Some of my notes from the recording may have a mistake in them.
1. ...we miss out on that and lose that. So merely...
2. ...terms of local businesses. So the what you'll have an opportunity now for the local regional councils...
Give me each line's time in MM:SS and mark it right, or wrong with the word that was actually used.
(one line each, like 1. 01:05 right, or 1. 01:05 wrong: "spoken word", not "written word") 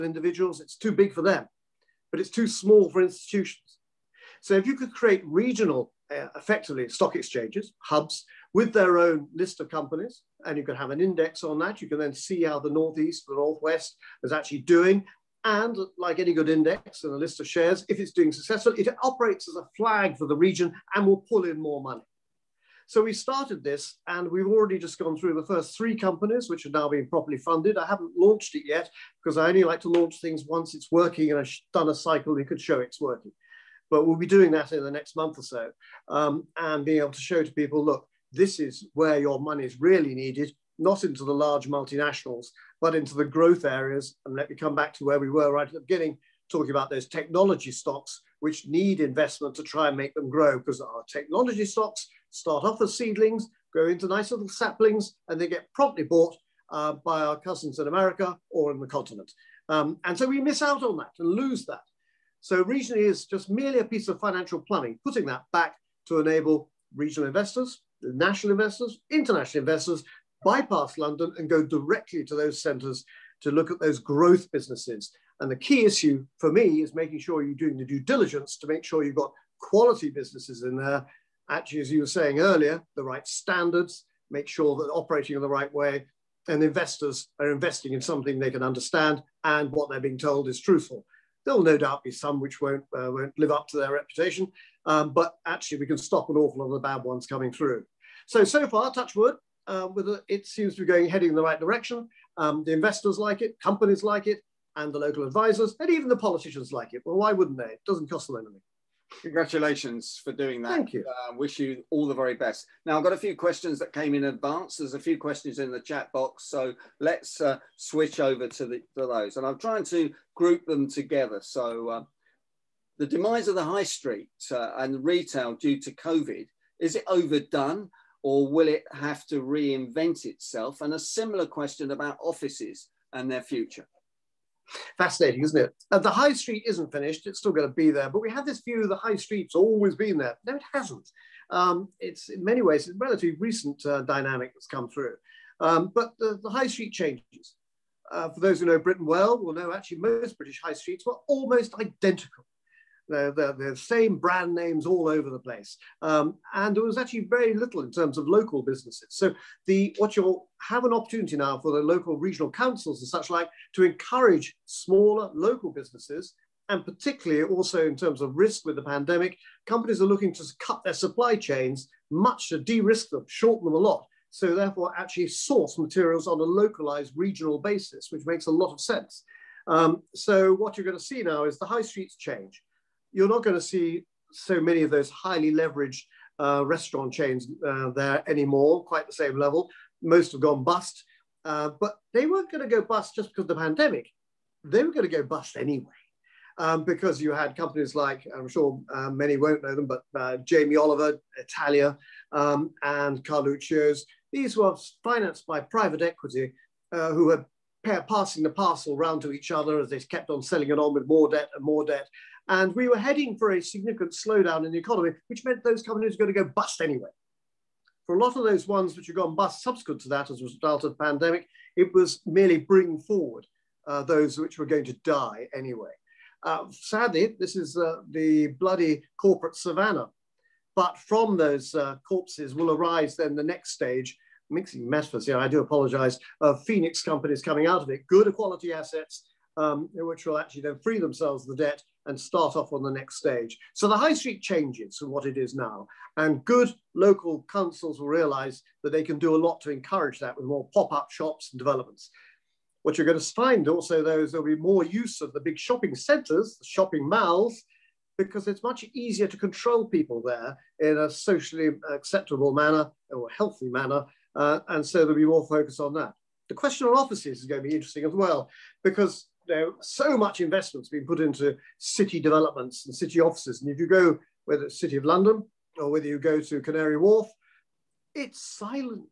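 1. 01:00 wrong: "regionally", not "merely"
2. 02:37 right.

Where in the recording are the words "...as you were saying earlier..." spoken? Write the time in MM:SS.
01:21.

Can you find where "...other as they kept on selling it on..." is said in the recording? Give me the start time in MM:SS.
03:29.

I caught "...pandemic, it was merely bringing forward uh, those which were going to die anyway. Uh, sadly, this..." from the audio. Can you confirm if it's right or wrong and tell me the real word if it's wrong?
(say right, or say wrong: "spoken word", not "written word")
right.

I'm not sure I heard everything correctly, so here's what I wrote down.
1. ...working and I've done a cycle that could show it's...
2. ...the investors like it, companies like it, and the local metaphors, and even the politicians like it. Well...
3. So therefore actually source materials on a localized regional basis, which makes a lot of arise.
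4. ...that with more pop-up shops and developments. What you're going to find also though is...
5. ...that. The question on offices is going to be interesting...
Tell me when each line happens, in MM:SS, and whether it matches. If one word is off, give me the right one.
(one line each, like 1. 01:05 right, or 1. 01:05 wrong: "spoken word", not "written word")
1. 00:30 right
2. 01:42 wrong: "advisors", not "metaphors"
3. 02:54 wrong: "sense", not "arise"
4. 04:10 right
5. 04:25 right.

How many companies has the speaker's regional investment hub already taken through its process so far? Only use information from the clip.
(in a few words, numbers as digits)
3.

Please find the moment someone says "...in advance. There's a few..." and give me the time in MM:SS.
01:54.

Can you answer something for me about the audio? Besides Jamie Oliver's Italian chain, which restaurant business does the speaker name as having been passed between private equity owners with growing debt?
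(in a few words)
Carluccio's.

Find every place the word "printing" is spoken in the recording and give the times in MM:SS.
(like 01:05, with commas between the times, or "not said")
not said.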